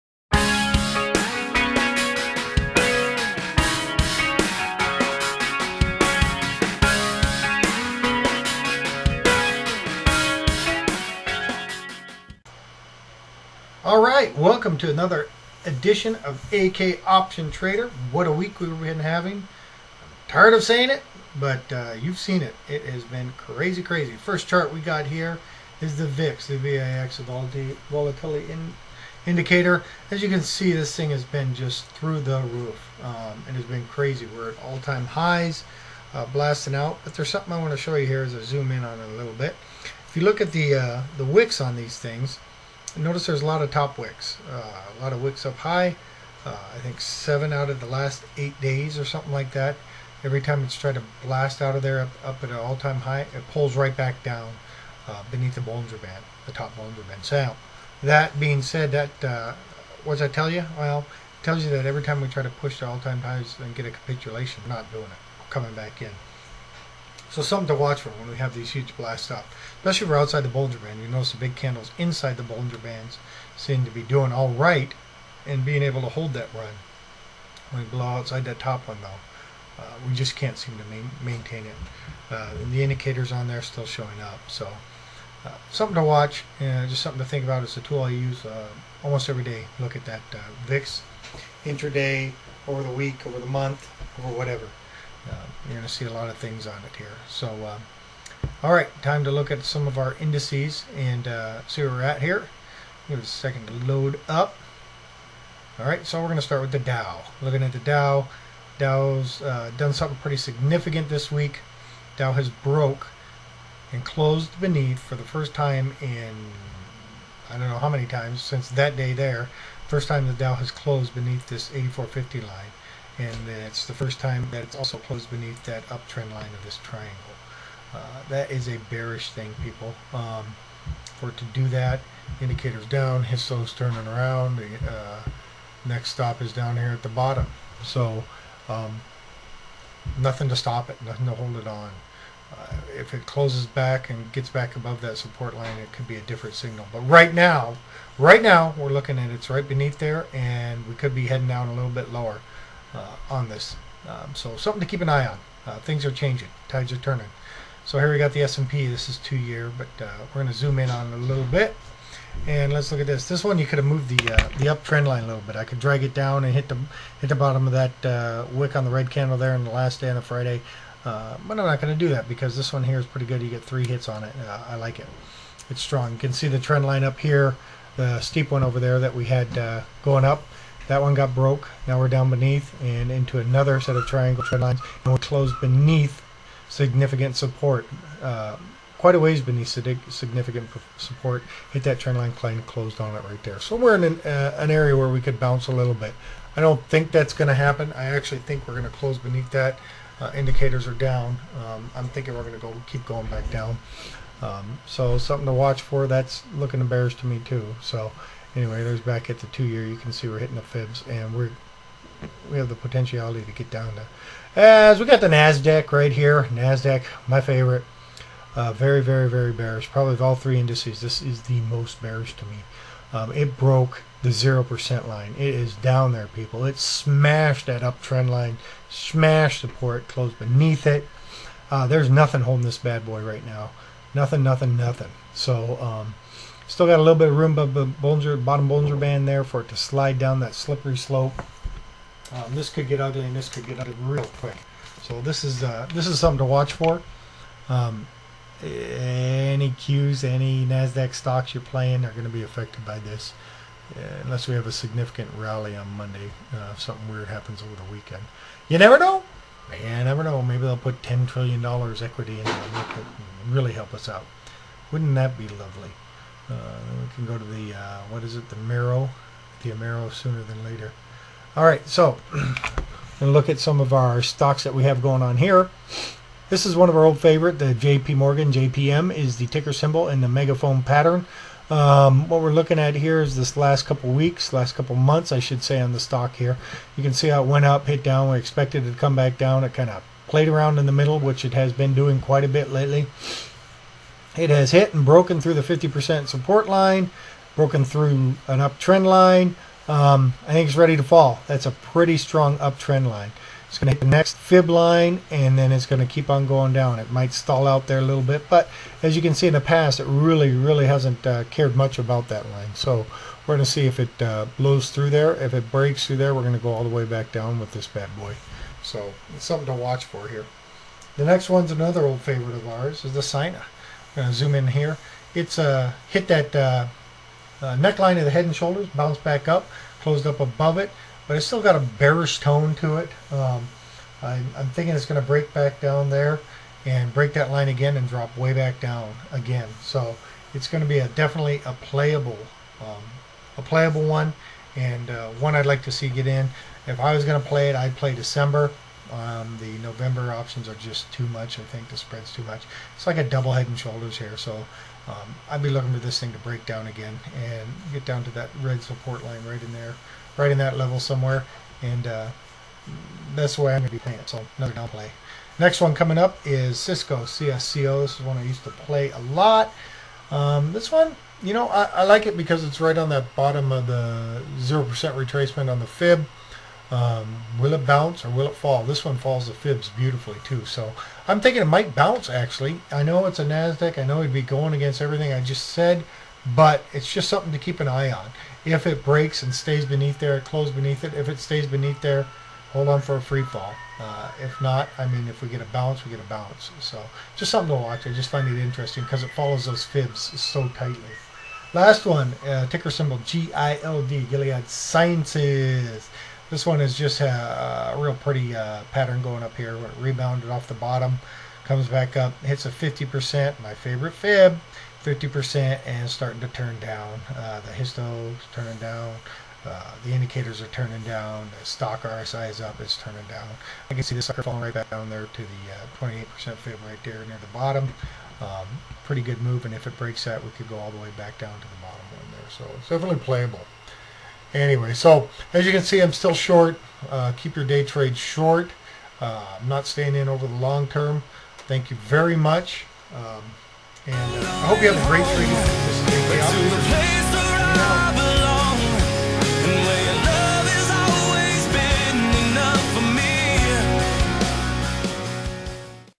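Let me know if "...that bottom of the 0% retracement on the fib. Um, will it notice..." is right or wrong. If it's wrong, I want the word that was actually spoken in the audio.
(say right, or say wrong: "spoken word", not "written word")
wrong: "bounce", not "notice".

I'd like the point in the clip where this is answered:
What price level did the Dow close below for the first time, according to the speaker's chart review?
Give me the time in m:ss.
2:01.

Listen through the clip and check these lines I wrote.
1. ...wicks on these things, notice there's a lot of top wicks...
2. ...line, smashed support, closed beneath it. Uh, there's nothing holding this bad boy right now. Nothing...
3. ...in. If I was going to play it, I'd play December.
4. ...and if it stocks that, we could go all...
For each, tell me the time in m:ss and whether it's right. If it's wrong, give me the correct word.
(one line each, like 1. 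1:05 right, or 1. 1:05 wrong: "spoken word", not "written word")
1. 0:41 right
2. 3:48 right
3. 5:46 right
4. 7:09 wrong: "breaks", not "stocks".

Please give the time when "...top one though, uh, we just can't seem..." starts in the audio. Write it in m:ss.
1:18.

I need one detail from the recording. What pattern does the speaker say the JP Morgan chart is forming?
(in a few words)
megaphone pattern.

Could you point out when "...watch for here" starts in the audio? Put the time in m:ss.
5:19.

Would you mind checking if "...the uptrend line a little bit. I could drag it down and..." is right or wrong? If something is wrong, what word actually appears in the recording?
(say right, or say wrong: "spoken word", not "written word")
right.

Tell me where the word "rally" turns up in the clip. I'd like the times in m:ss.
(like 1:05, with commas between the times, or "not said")
4:15.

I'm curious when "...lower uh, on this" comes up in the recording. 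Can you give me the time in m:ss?
2:32.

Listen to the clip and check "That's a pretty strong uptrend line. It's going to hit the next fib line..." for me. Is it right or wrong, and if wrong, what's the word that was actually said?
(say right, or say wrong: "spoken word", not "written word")
right.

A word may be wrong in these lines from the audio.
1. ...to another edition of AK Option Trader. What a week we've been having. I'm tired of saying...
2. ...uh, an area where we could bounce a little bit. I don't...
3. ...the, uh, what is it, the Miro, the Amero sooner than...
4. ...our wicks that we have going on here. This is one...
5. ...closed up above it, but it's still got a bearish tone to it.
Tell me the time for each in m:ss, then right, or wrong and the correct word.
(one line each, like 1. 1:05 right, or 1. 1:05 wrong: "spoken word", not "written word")
1. 0:14 right
2. 3:14 right
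3. 4:27 right
4. 4:33 wrong: "stocks", not "wicks"
5. 5:30 right.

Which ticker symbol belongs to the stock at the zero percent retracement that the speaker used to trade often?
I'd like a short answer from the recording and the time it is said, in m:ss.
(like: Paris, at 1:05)
CSCO, at 6:07.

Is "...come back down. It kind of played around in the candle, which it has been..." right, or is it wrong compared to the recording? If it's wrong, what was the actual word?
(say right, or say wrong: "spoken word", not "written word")
wrong: "middle", not "candle".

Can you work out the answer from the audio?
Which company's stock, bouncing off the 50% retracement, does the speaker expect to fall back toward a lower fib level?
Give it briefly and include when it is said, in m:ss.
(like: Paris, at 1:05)
Gilead Sciences, at 6:44.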